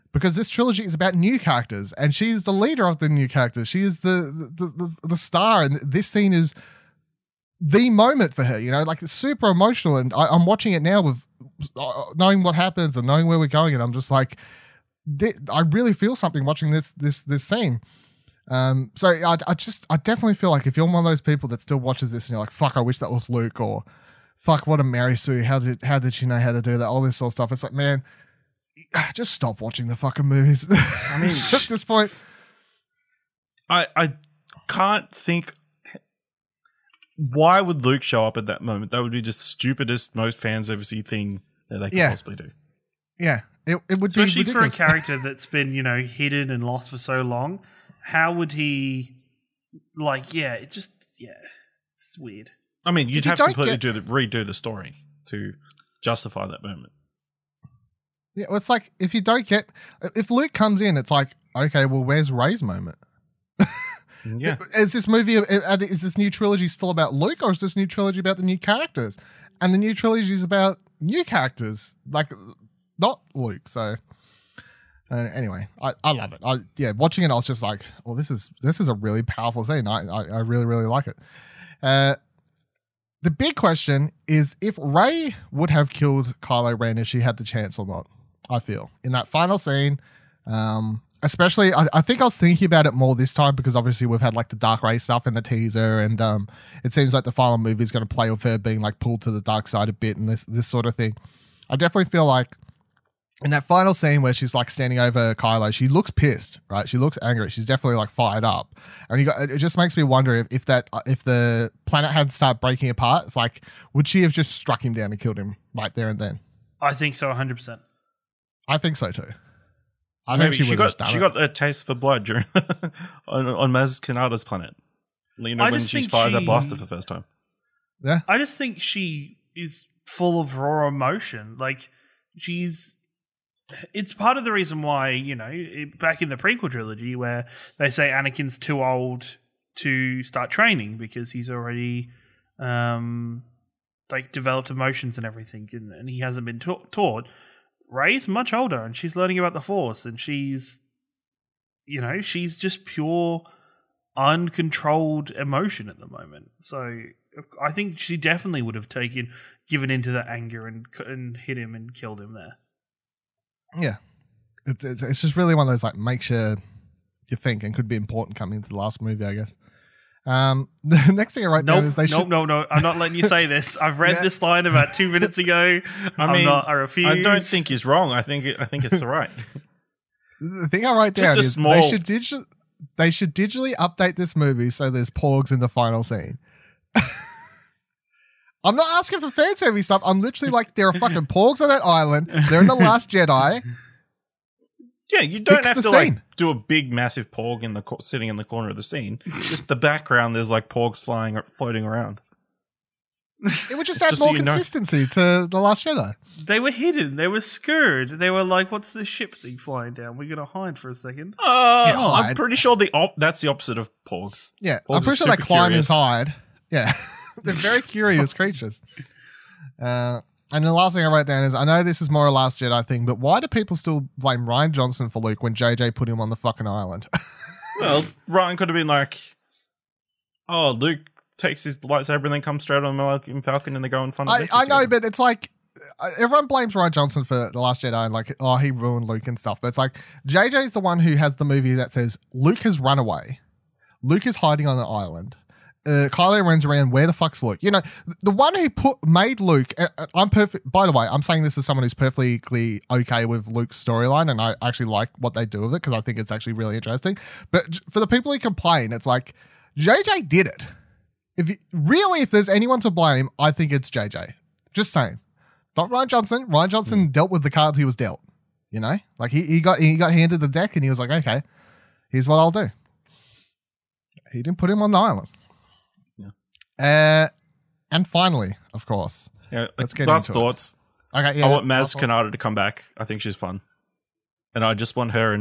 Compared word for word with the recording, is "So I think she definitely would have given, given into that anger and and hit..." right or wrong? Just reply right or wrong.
wrong.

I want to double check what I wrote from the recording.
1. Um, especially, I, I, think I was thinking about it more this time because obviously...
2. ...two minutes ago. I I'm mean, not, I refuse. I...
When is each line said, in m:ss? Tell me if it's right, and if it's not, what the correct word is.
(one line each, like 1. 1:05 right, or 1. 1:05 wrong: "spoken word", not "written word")
1. 1:30 right
2. 2:54 right.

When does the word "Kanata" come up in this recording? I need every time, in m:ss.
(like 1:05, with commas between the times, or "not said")
2:03, 4:41.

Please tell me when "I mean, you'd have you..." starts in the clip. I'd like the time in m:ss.
0:52.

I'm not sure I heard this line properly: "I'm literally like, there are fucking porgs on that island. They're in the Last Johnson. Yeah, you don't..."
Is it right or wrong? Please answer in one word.
wrong.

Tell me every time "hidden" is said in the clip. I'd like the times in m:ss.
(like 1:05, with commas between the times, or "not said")
0:46, 3:26.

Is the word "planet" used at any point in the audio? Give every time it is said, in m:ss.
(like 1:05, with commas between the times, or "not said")
1:51, 2:04.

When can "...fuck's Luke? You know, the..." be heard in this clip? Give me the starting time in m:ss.
4:07.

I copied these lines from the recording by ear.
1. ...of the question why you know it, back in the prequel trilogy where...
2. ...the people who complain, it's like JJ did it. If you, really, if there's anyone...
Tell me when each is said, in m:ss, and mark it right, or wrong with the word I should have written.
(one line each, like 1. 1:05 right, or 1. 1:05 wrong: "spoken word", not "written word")
1. 2:14 wrong: "reason", not "question"
2. 4:17 right.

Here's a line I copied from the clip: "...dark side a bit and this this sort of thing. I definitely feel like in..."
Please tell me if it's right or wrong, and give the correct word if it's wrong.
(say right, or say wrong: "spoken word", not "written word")
right.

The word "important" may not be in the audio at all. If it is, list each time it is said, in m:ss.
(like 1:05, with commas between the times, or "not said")
2:47.